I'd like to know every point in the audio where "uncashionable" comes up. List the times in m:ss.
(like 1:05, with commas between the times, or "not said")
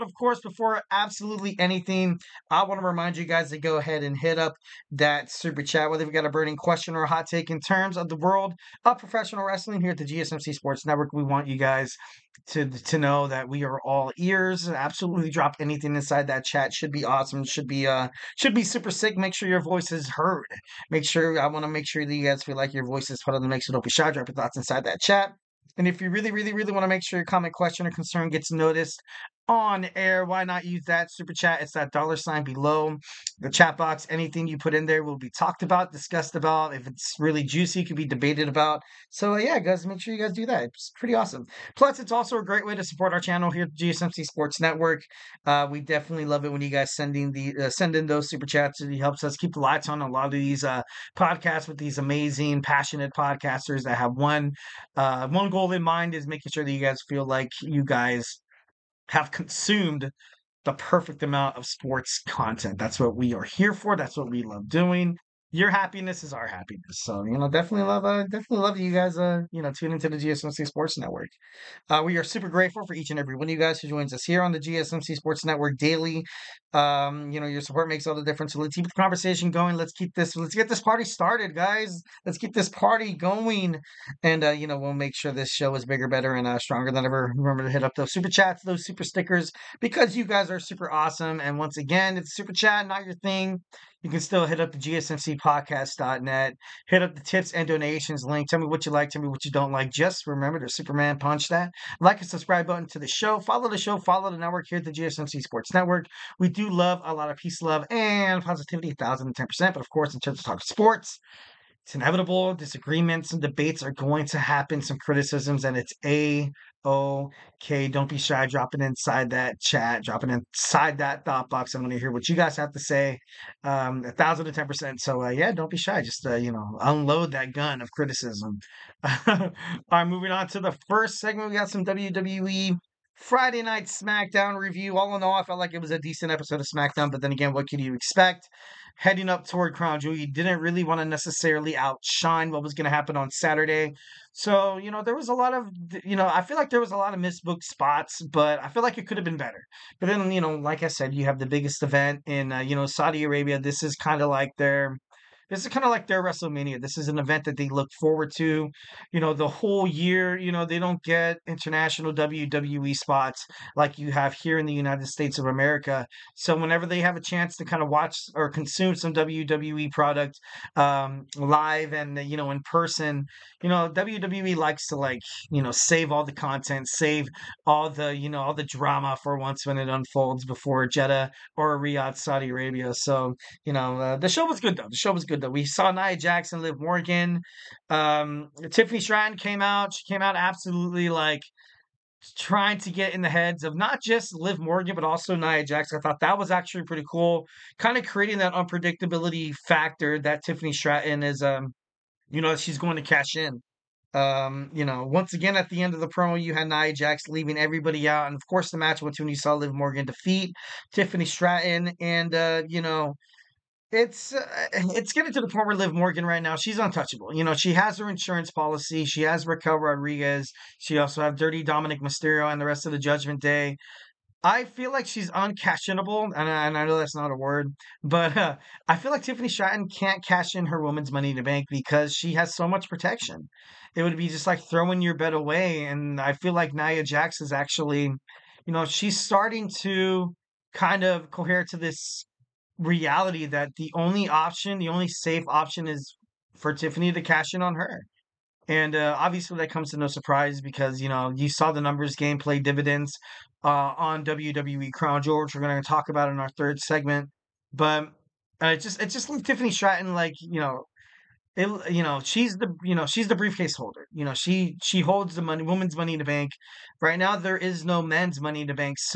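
3:45.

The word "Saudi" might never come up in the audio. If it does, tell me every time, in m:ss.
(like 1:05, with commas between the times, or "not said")
2:32, 3:02.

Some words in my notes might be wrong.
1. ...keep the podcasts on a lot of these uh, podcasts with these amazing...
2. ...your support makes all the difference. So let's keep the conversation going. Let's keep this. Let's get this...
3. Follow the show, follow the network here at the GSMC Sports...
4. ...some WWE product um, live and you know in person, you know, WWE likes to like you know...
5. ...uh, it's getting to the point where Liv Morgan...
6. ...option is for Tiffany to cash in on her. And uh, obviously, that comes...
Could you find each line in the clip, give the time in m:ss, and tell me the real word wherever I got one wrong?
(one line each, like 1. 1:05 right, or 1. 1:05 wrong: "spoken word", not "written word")
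1. 0:49 wrong: "lights", not "podcasts"
2. 1:17 right
3. 1:43 right
4. 2:48 right
5. 3:34 right
6. 4:05 right.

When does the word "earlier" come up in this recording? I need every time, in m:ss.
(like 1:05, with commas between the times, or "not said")
not said.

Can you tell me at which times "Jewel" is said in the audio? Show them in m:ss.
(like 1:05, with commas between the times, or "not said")
2:19, 4:15.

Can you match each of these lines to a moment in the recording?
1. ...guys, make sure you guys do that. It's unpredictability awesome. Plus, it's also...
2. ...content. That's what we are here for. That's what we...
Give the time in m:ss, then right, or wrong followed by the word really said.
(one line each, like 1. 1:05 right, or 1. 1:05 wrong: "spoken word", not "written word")
1. 0:39 wrong: "pretty", not "unpredictability"
2. 1:02 right.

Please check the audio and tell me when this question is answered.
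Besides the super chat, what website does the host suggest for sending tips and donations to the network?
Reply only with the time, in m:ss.
1:34.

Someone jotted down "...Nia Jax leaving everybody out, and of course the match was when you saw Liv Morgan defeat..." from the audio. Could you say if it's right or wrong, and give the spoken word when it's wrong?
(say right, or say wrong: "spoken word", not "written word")
right.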